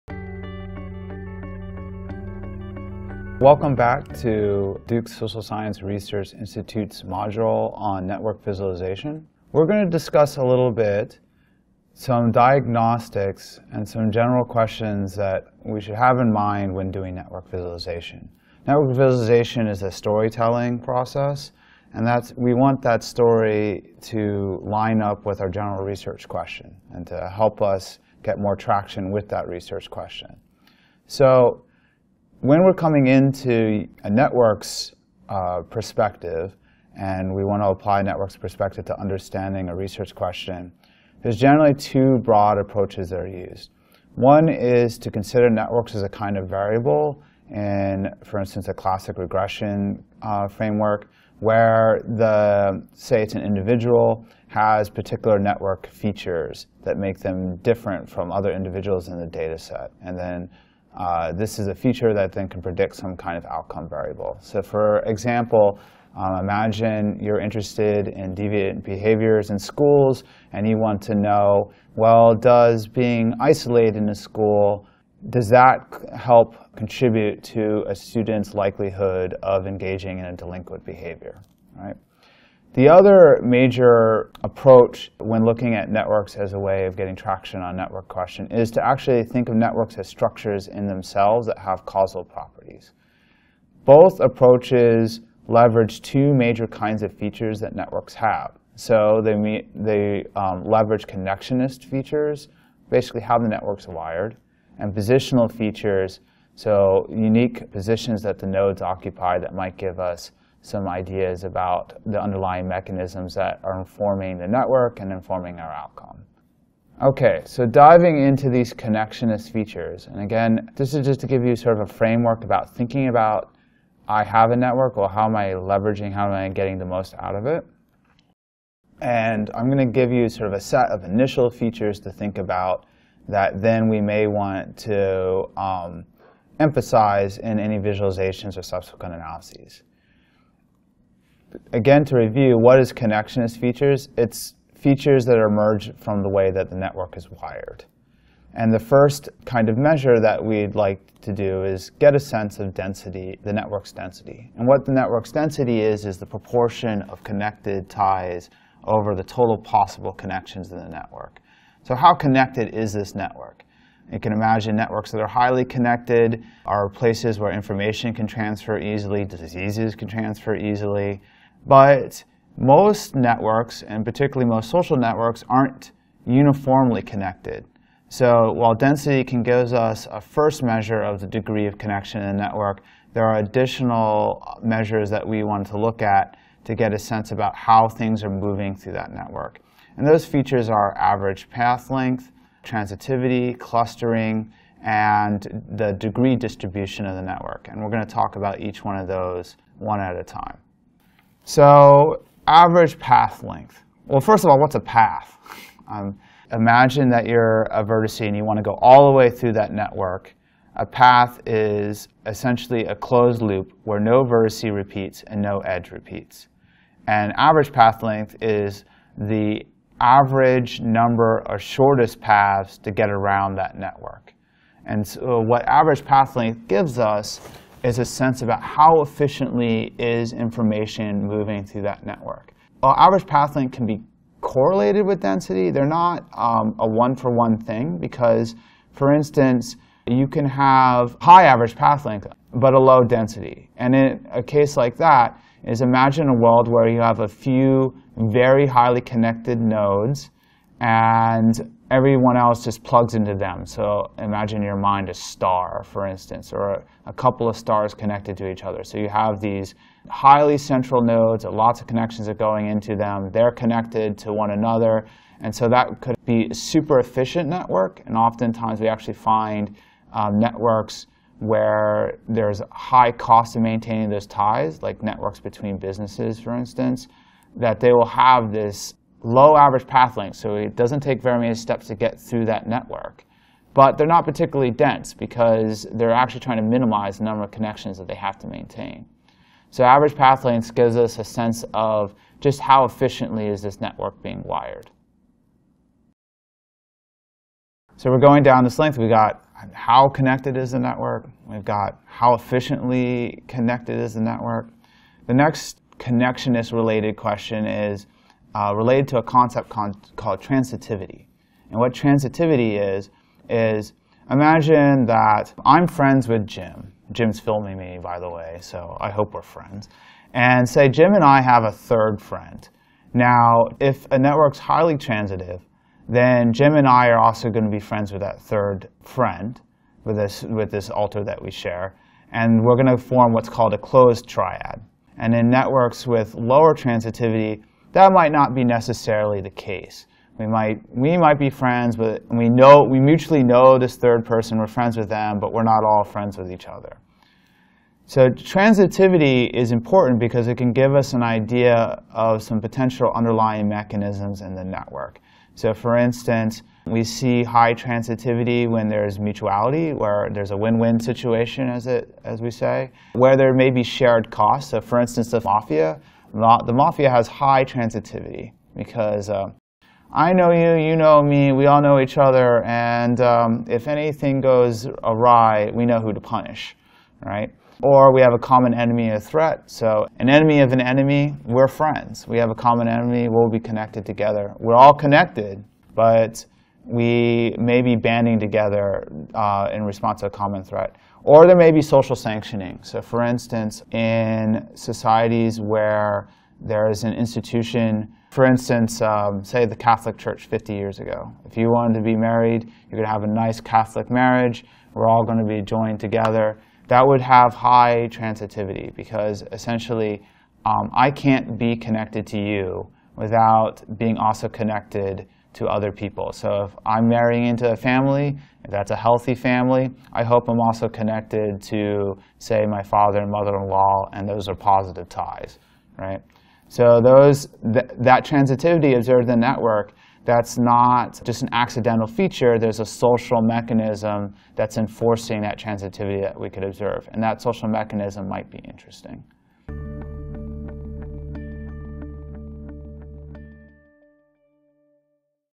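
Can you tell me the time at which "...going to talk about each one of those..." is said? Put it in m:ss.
3:17.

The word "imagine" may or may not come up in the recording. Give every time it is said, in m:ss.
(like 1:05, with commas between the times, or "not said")
1:06, 2:44, 3:26, 4:05, 4:14, 5:14.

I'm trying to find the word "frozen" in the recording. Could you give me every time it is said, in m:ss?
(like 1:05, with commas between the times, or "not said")
not said.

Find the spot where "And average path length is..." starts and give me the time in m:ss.
3:37.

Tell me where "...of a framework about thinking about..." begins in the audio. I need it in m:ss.
2:01.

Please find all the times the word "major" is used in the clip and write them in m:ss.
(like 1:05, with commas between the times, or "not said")
1:23, 1:36.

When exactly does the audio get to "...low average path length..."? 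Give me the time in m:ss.
4:39.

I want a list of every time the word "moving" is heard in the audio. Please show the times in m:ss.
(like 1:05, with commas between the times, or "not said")
3:08, 3:51.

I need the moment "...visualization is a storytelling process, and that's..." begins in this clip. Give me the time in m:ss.
0:18.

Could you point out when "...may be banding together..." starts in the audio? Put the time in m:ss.
6:27.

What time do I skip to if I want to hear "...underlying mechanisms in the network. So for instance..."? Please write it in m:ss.
5:53.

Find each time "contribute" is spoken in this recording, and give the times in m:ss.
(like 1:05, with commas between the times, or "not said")
1:16.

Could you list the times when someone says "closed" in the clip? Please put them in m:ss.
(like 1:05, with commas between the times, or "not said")
3:32, 5:33.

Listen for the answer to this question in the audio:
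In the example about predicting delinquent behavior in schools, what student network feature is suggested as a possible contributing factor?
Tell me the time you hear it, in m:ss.
1:13.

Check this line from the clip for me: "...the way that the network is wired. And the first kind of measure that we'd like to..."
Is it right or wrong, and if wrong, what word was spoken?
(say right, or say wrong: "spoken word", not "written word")
right.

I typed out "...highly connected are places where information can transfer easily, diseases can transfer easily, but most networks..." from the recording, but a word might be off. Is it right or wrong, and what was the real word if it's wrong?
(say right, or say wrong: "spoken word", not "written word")
right.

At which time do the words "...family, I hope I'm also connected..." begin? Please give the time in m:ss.
6:59.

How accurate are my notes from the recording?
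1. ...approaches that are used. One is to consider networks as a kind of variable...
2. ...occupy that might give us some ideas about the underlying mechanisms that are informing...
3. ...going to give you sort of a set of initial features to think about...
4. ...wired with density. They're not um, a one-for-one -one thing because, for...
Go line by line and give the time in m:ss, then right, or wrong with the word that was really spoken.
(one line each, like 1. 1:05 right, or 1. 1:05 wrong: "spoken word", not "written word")
1. 0:42 right
2. 1:48 right
3. 2:09 right
4. 3:54 wrong: "correlated", not "wired".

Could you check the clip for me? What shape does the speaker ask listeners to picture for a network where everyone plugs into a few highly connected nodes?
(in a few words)
A star.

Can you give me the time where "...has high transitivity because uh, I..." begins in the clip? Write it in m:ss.
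6:07.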